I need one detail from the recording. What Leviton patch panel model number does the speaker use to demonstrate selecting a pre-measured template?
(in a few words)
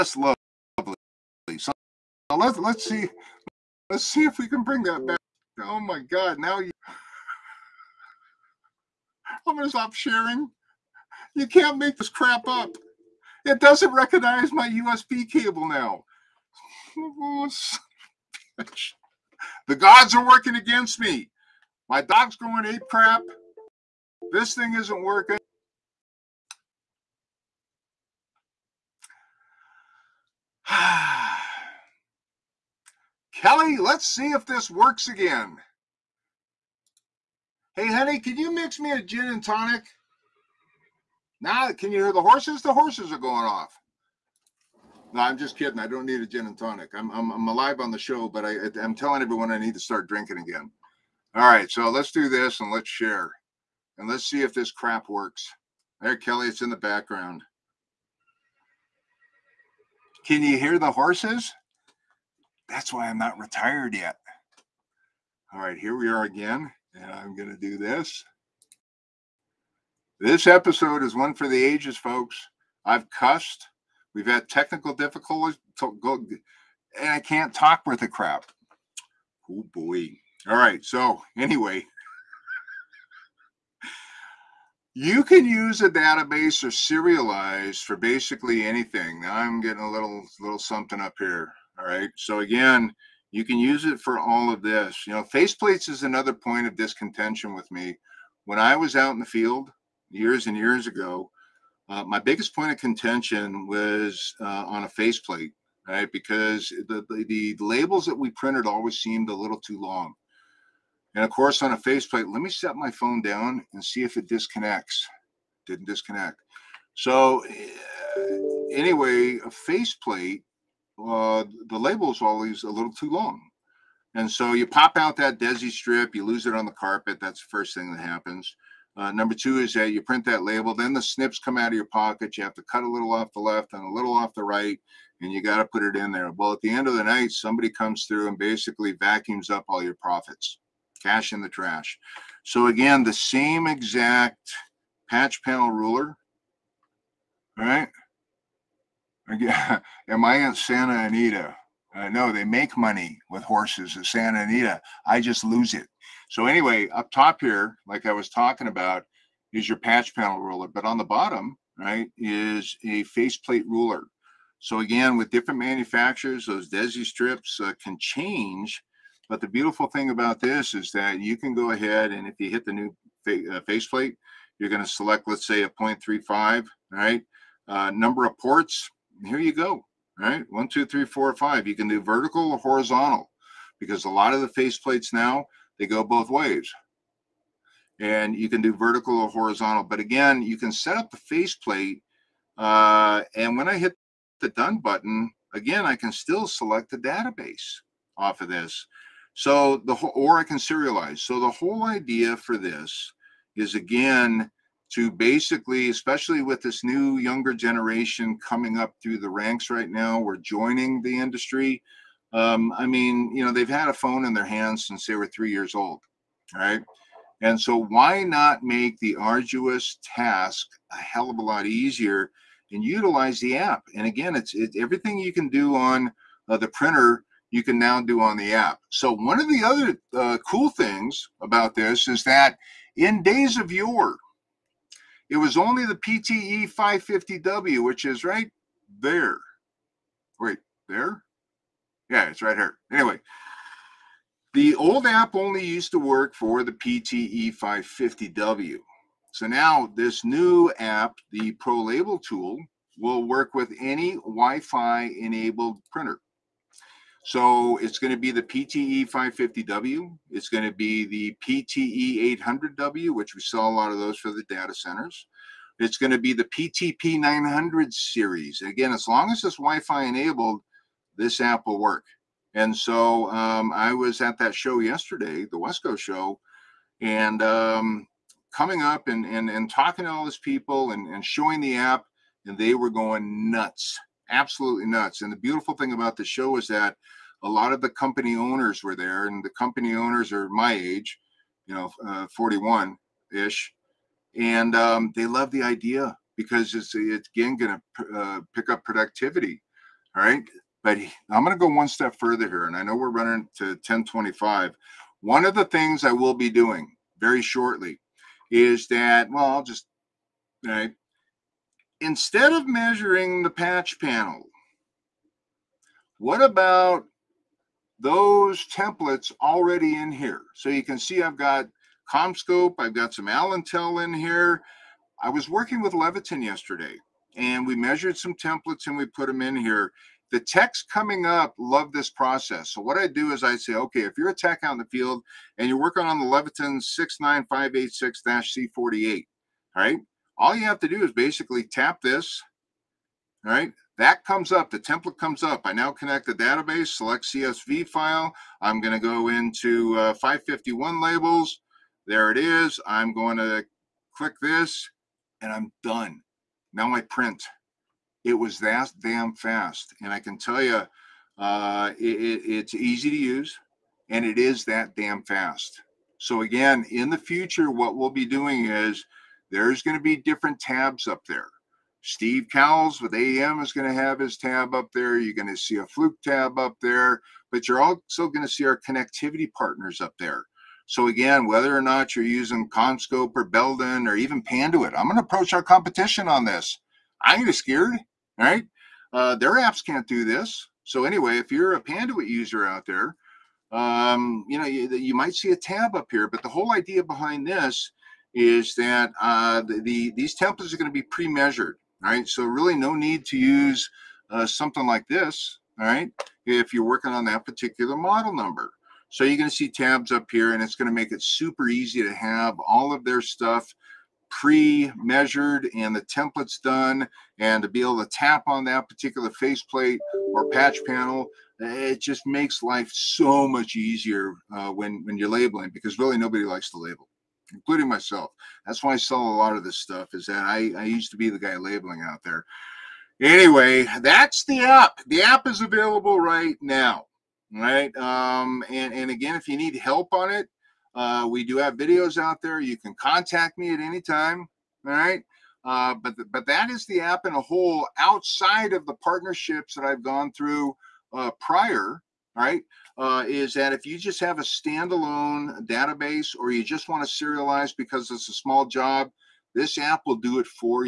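69586-C48.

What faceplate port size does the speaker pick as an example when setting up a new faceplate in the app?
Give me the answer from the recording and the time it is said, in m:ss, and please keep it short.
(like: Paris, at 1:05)
0.35, at 2:55.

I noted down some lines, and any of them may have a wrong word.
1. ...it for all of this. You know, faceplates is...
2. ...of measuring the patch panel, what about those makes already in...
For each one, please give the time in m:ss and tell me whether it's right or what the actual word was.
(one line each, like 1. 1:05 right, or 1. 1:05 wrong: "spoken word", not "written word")
1. 1:33 right
2. 5:12 wrong: "templates", not "makes".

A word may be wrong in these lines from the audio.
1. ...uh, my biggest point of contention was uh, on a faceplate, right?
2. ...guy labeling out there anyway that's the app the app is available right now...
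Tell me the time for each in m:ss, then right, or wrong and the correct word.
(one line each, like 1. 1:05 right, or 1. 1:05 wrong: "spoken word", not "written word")
1. 1:41 right
2. 7:11 right.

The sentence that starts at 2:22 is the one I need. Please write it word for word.
So, again, the same exact patch panel ruler.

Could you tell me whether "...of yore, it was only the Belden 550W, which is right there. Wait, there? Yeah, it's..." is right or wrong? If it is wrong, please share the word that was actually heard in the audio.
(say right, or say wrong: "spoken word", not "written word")
wrong: "PTE", not "Belden".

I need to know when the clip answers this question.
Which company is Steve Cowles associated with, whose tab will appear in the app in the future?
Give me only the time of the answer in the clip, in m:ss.
6:13.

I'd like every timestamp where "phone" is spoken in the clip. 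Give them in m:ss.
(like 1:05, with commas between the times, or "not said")
1:52, 3:33.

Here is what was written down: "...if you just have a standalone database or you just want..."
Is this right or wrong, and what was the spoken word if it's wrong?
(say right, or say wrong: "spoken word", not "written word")
right.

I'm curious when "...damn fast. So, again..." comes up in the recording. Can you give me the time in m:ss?
6:04.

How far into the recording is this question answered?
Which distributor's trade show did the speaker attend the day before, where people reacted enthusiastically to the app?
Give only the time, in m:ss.
4:35.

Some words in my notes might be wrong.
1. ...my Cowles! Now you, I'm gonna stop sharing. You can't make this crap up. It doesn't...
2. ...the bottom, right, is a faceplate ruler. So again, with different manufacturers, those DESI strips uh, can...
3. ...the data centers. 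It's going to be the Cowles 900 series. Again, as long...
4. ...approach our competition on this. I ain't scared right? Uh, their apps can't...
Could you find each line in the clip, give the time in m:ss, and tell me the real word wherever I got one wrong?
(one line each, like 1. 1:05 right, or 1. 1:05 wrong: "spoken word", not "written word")
1. 0:05 wrong: "God", not "Cowles"
2. 2:40 right
3. 4:24 wrong: "PTP", not "Cowles"
4. 6:25 right.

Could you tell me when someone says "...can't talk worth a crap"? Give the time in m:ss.
1:17.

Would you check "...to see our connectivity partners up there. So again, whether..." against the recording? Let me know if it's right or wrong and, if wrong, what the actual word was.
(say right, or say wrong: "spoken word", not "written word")
right.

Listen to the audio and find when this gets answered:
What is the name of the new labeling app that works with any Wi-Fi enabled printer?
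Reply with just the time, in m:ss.
4:11.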